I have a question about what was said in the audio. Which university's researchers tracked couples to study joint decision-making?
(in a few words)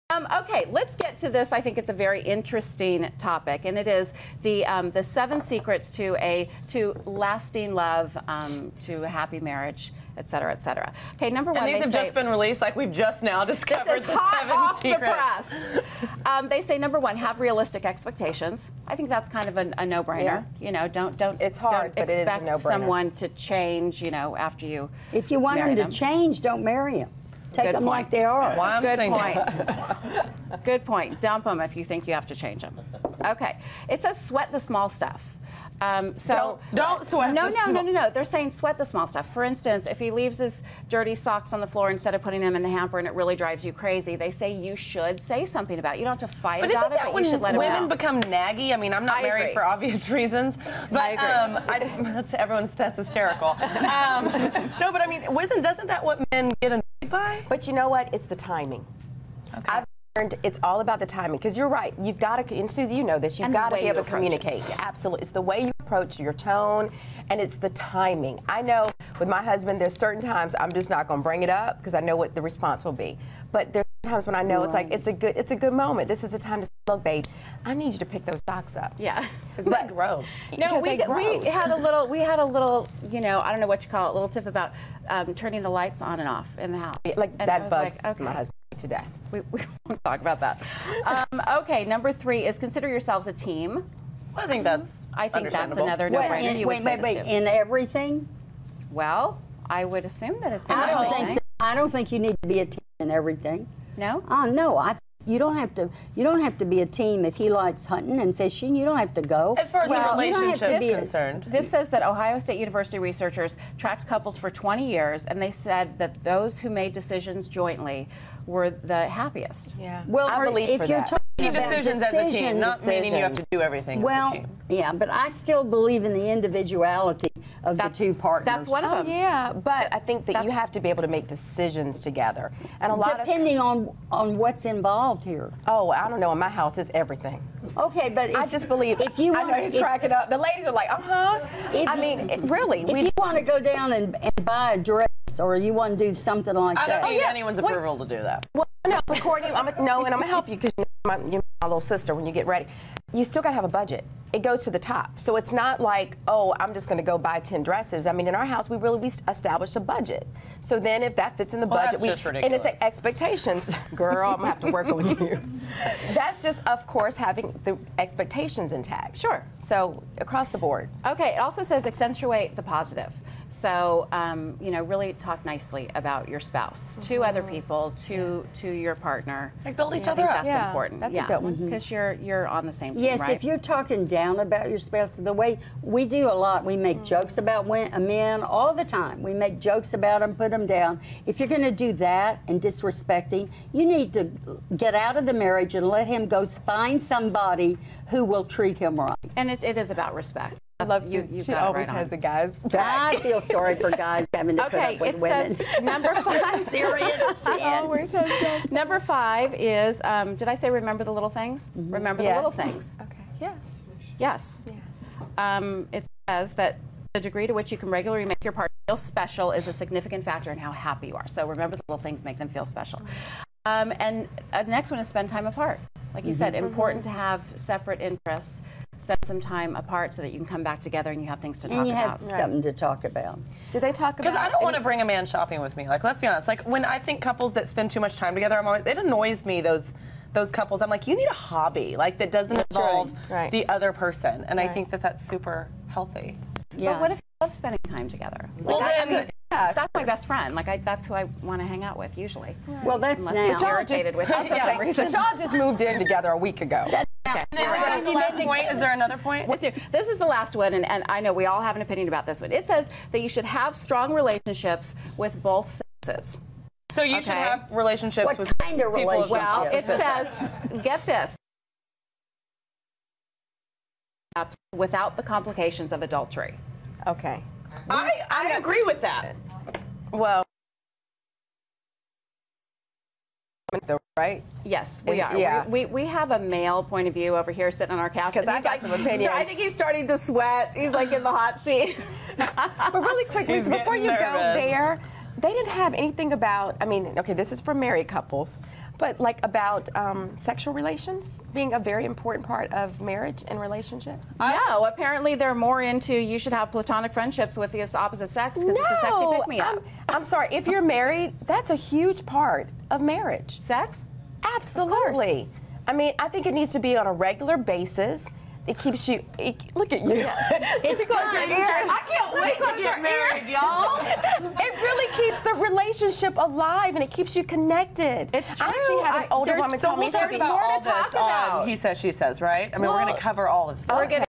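Ohio State University.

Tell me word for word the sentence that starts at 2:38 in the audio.
I mean, in our house, we really we established a budget.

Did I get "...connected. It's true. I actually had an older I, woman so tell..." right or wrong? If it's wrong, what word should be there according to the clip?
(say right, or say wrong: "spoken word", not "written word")
right.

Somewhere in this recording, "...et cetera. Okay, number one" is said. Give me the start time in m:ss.
0:10.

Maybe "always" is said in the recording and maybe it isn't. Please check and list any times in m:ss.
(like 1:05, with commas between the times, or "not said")
3:21, 3:27, 3:58.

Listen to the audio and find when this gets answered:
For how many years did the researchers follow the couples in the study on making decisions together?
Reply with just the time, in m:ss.
1:54.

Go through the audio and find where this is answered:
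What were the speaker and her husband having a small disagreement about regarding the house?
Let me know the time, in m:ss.
1:25.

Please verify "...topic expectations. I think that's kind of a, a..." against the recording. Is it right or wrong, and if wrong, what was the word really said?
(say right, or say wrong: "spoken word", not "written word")
wrong: "realistic", not "topic".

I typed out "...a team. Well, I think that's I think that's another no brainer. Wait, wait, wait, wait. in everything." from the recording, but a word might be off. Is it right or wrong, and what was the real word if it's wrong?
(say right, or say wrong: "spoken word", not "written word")
right.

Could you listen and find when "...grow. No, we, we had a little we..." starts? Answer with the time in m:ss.
1:19.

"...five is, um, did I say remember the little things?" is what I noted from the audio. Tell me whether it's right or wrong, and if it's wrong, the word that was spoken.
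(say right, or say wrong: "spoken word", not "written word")
right.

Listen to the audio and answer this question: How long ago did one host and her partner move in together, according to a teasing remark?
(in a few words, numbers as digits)
a week ago.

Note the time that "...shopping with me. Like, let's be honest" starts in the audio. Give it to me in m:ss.
3:55.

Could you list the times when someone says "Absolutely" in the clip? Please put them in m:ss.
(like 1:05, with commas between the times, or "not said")
1:04, 5:14.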